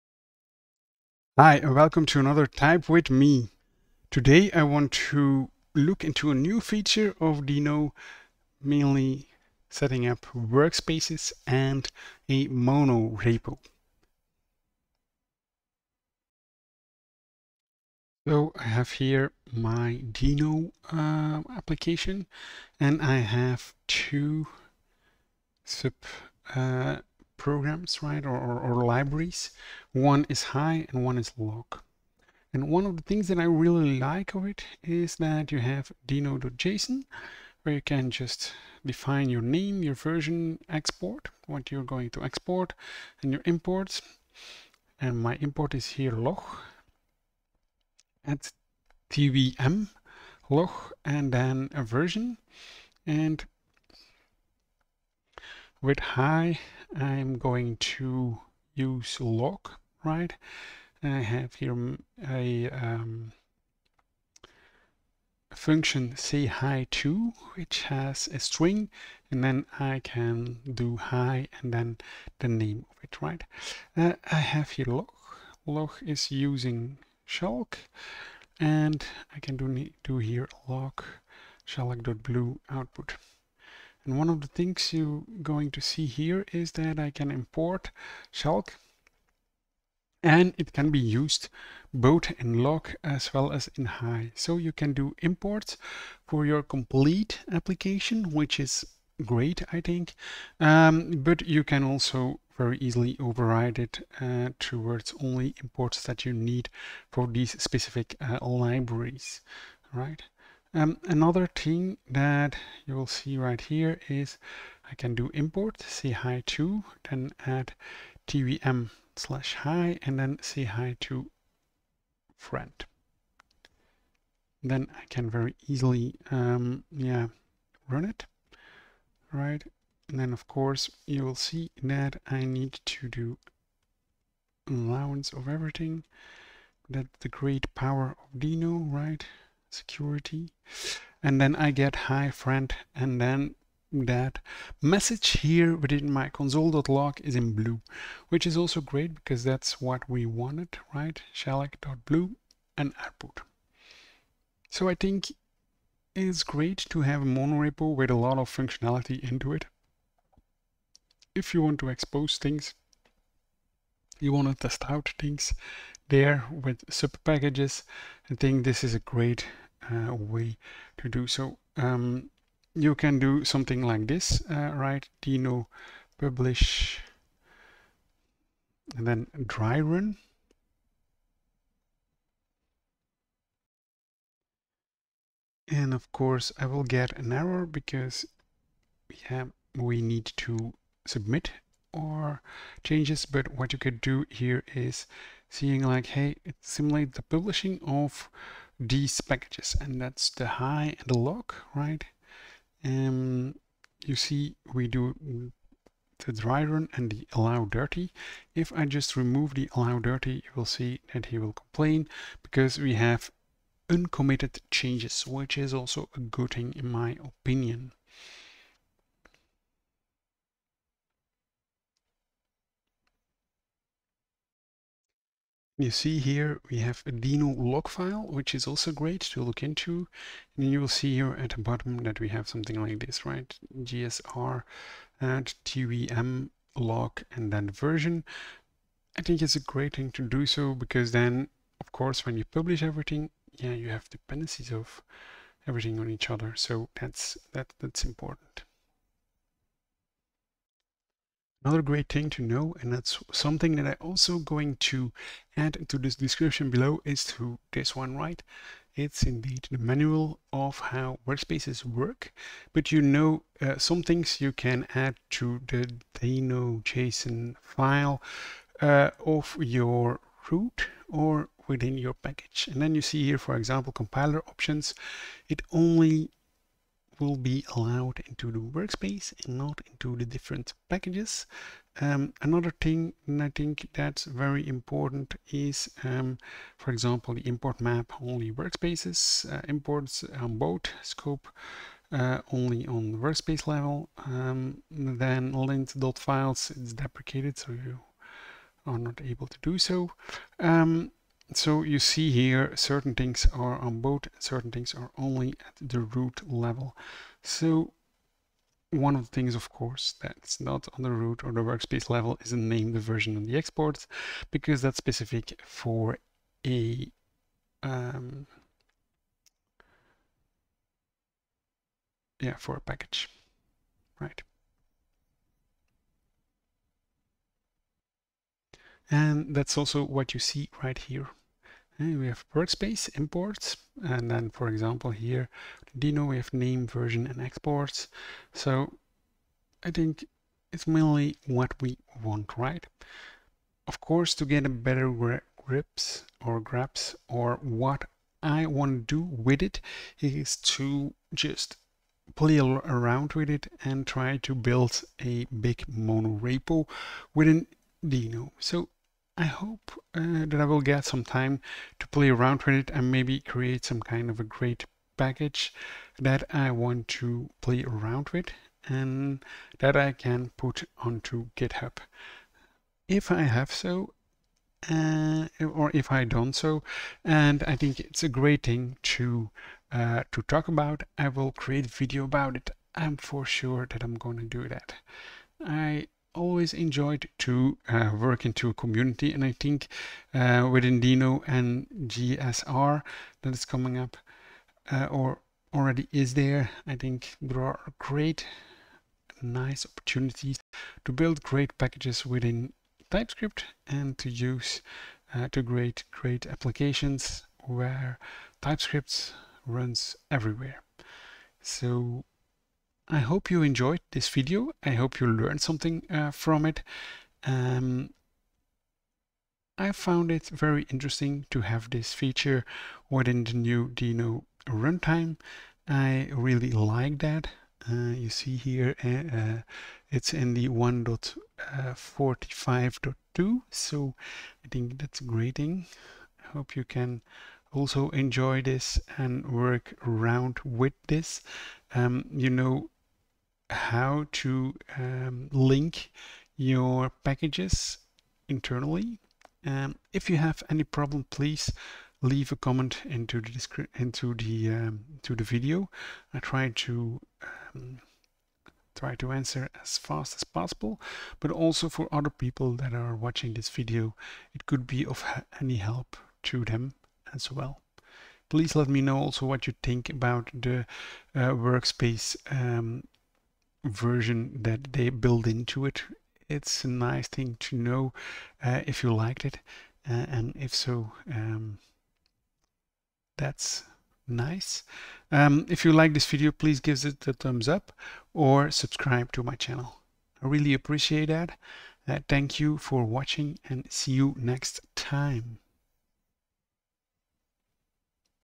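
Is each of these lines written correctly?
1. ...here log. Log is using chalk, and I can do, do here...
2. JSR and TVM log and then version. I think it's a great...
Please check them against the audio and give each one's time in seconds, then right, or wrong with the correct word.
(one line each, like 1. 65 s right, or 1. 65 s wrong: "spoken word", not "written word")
1. 74 s right
2. 233 s right.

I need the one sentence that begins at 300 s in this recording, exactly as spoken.
Um, so you see here certain things are on both, certain things are only at the root level.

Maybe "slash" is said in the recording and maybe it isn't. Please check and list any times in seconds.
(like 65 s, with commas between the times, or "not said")
119 s.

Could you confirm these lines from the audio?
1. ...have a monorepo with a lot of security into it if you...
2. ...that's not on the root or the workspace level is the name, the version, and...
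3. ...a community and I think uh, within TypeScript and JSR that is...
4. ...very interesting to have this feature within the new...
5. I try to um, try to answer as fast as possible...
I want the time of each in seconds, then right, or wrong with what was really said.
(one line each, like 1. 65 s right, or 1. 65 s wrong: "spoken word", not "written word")
1. 157 s wrong: "functionality", not "security"
2. 310 s right
3. 388 s wrong: "Deno", not "TypeScript"
4. 420 s right
5. 456 s right.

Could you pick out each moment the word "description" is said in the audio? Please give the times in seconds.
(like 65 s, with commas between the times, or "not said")
256 s.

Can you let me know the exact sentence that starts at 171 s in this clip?
Um, you can do something like this, uh, right?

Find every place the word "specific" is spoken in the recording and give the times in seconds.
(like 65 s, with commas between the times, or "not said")
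107 s, 314 s.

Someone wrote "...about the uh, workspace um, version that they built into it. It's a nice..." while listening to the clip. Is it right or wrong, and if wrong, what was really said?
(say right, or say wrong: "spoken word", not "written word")
right.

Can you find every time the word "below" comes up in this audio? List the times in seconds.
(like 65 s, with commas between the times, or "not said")
256 s.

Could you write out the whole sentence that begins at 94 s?
So you can do imports for your complete application, which is great, I think.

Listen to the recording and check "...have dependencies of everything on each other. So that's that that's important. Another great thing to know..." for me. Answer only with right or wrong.
right.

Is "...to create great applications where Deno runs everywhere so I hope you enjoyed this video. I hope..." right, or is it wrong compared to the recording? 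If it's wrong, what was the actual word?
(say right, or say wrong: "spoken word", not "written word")
wrong: "TypeScript", not "Deno".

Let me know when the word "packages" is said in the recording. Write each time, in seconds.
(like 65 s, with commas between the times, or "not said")
167 s, 199 s, 272 s, 280 s, 322 s, 365 s, 401 s, 447 s.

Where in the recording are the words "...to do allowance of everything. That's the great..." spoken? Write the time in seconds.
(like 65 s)
132 s.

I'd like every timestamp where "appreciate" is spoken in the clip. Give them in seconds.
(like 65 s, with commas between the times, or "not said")
490 s.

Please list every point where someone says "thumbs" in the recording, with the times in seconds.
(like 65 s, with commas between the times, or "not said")
487 s.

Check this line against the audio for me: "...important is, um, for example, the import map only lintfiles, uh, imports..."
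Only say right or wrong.
wrong.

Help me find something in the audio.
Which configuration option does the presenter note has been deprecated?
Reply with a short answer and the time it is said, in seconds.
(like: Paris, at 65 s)
lint.files, at 295 s.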